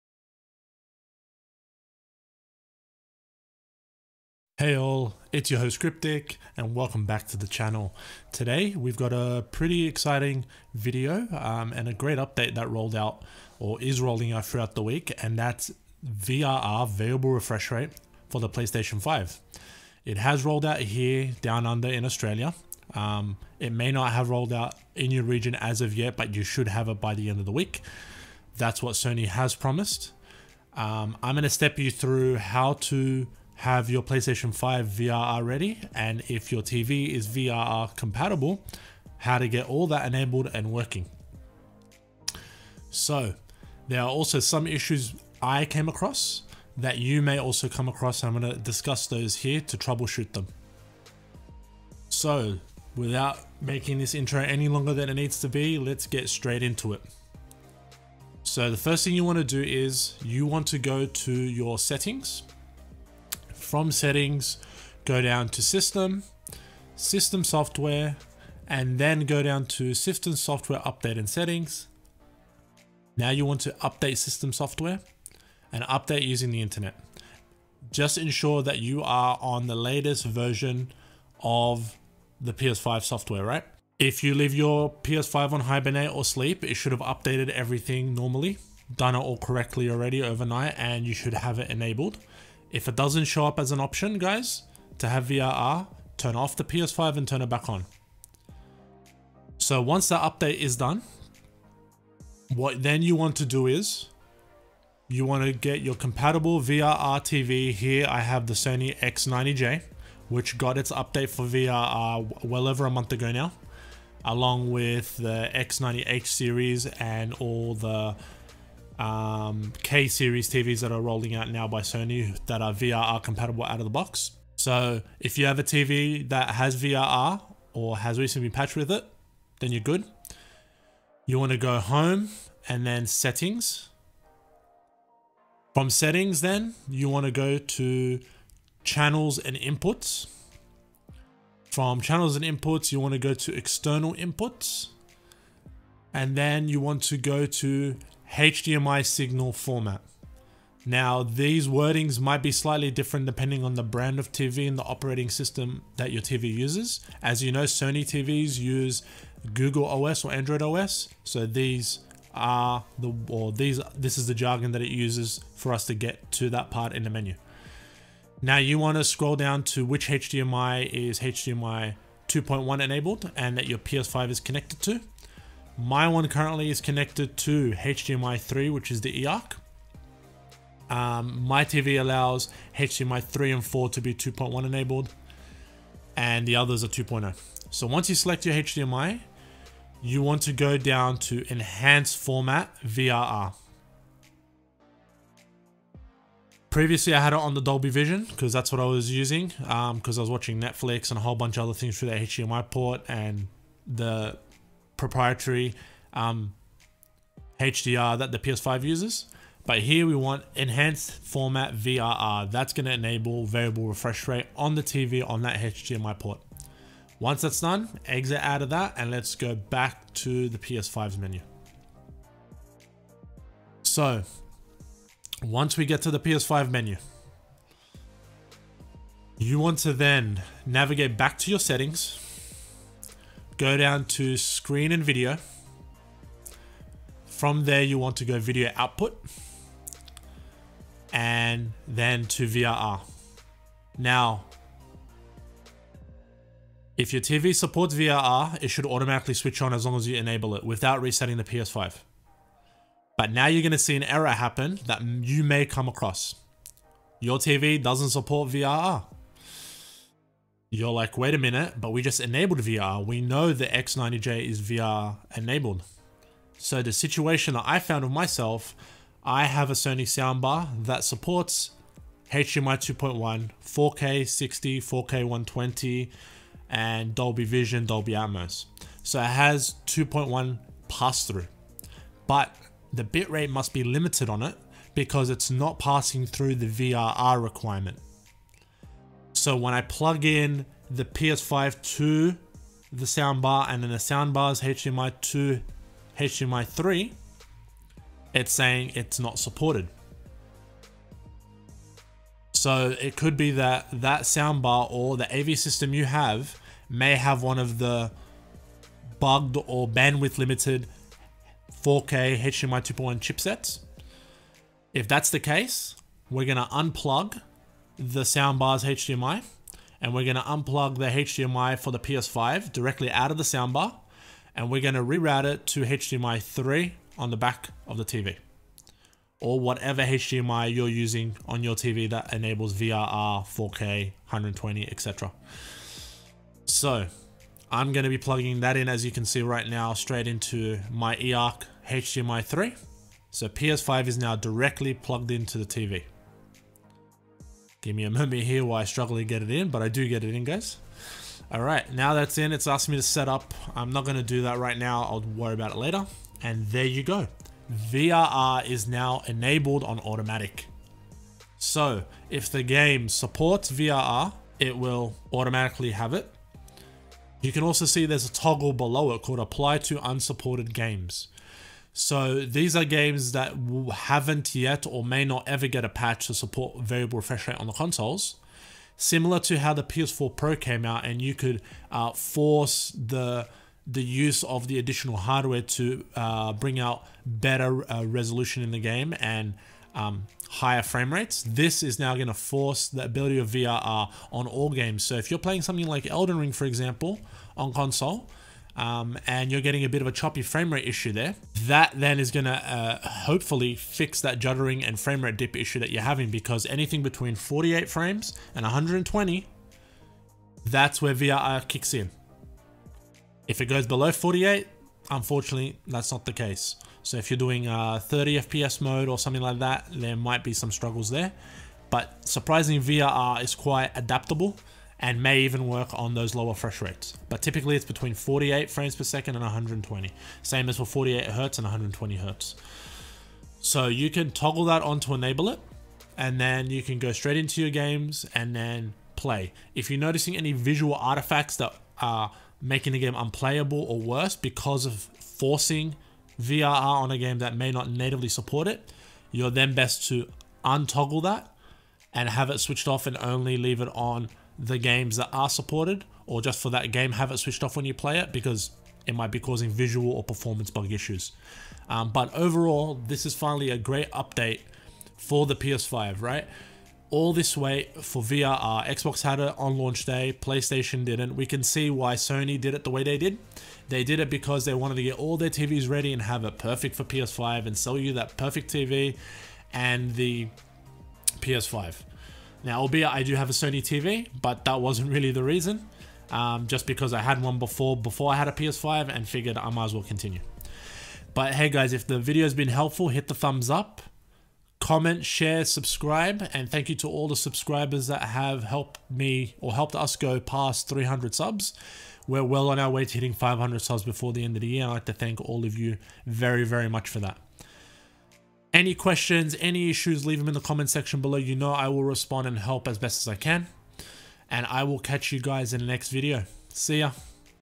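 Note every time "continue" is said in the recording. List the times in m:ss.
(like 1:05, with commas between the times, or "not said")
8:10.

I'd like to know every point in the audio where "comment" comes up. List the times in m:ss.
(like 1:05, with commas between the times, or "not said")
8:14, 8:30.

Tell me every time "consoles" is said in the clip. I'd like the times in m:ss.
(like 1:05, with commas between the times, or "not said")
6:17, 6:37.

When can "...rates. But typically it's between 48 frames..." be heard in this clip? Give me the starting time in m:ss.
7:06.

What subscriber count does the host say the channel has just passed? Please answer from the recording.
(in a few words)
300.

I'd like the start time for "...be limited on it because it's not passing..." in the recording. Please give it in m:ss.
4:43.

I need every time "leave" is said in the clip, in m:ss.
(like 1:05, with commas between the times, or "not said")
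1:24, 7:33, 8:30.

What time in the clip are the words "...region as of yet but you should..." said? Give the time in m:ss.
0:25.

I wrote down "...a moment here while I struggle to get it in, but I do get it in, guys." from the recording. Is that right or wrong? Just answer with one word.
right.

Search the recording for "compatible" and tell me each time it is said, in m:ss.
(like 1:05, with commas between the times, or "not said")
0:37, 1:45, 2:03.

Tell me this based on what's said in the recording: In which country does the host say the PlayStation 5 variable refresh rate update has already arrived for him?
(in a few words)
Australia.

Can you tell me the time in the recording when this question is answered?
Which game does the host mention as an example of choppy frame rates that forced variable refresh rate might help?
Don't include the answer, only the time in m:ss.
6:36.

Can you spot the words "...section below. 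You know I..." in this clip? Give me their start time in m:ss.
8:30.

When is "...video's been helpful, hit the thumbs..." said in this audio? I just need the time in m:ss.
8:12.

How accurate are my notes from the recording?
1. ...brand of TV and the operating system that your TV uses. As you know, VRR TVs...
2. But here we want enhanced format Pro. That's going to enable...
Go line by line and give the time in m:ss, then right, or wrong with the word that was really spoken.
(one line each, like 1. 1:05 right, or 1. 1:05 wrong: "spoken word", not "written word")
1. 2:33 wrong: "Sony", not "VRR"
2. 3:29 wrong: "VRR", not "Pro".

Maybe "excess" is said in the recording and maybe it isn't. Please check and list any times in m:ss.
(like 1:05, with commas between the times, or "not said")
not said.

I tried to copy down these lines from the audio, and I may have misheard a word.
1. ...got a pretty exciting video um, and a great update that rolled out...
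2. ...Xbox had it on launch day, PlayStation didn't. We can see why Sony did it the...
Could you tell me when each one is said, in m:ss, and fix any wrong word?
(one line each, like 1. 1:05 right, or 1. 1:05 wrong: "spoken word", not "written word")
1. 0:08 right
2. 7:48 right.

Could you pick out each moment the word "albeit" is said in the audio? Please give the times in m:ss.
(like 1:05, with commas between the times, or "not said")
8:02.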